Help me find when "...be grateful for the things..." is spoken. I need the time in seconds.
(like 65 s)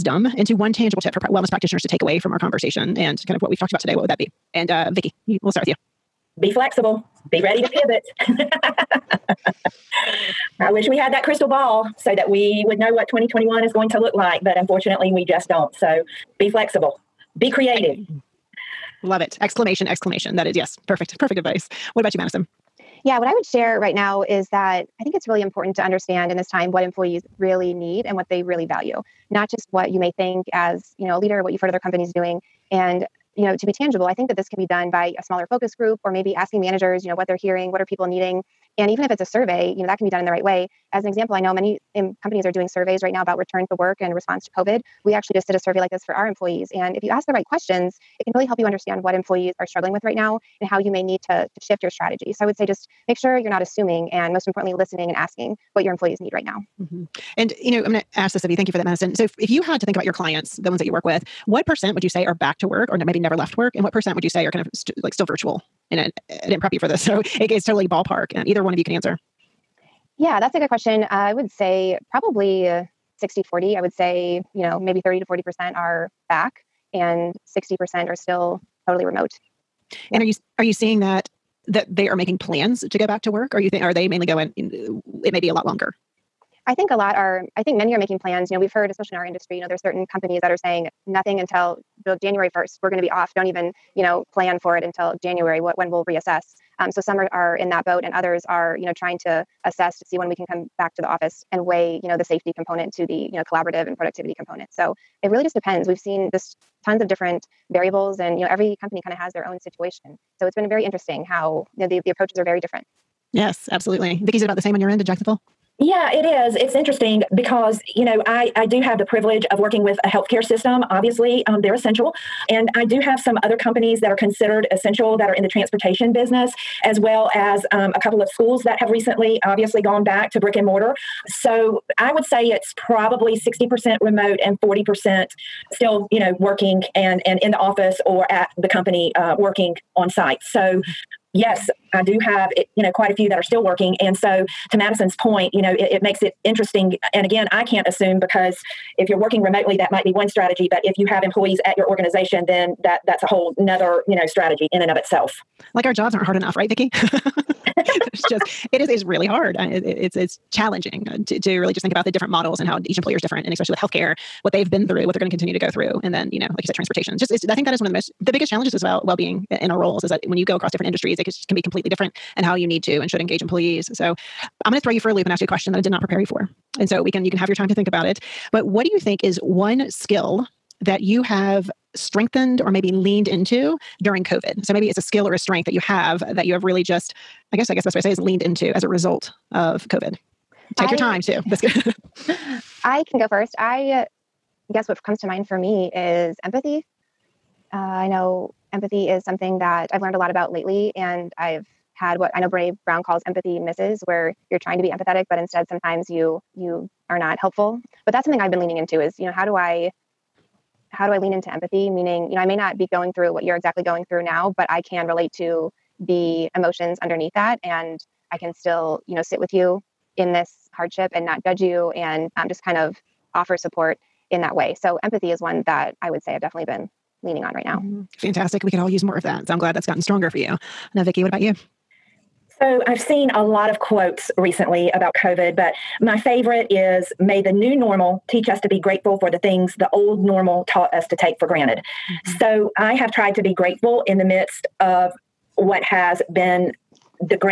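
238 s.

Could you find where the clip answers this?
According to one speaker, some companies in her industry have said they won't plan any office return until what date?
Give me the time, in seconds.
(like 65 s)
92 s.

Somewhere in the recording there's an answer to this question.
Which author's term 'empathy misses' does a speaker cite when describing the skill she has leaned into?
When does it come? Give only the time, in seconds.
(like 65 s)
202 s.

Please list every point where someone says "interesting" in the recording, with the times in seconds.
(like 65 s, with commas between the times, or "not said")
110 s, 116 s, 146 s.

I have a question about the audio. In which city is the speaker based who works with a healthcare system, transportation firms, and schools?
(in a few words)
Jacksonville.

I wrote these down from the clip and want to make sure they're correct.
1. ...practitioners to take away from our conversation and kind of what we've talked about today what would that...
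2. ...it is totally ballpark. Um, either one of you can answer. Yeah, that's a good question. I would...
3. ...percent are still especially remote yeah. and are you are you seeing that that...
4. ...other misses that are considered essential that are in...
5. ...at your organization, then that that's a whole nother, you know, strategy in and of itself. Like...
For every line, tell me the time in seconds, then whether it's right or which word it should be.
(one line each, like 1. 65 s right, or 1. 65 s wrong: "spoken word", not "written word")
1. 1 s right
2. 67 s right
3. 77 s wrong: "totally", not "especially"
4. 123 s wrong: "companies", not "misses"
5. 151 s right.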